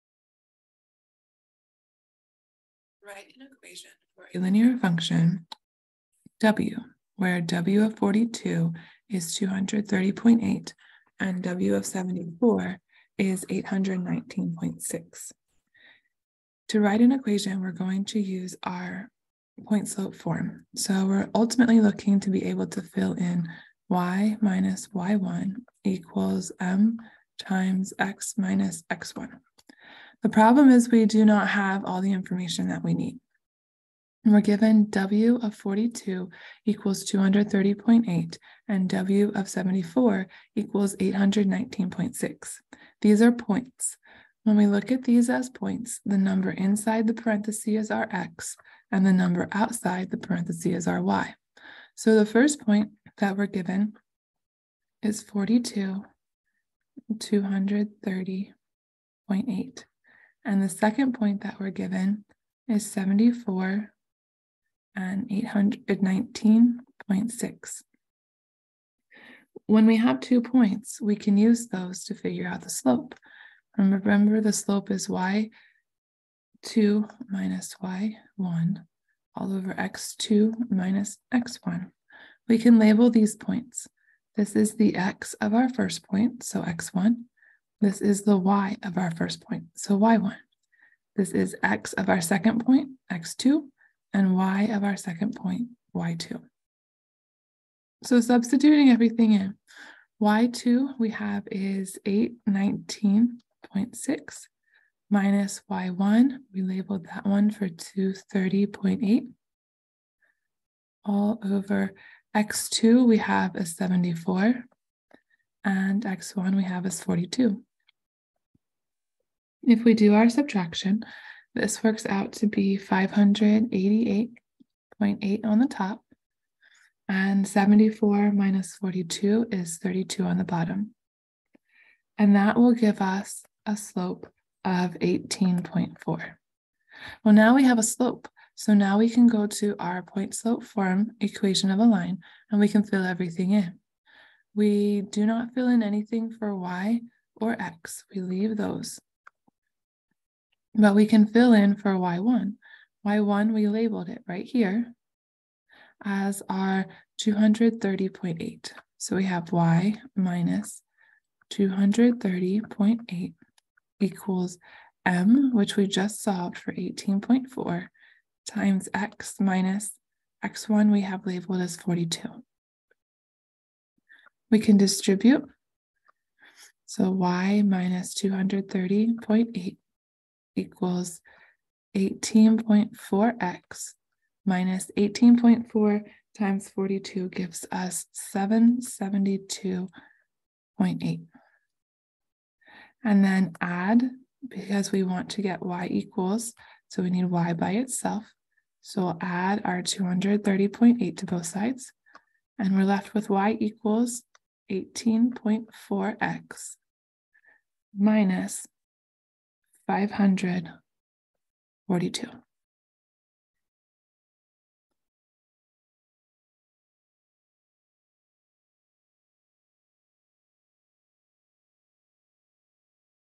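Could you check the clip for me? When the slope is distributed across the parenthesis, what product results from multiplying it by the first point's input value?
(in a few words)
772.8.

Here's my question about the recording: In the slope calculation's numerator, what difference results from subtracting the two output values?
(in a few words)
588.8.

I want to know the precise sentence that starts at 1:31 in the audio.
This is x of our second point, x2, and y of our second point, y2.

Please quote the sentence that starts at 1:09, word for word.
When we have two points, we can use those to figure out the slope.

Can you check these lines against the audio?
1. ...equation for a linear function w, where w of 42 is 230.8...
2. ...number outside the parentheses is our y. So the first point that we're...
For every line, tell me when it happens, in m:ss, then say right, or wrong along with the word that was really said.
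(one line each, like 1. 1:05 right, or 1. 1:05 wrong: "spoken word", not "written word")
1. 0:03 right
2. 0:49 right.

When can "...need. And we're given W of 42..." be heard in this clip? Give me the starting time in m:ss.
0:32.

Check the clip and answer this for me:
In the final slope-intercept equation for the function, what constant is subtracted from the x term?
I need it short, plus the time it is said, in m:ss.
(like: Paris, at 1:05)
542, at 3:29.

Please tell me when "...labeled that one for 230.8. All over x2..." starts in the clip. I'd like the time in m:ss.
1:46.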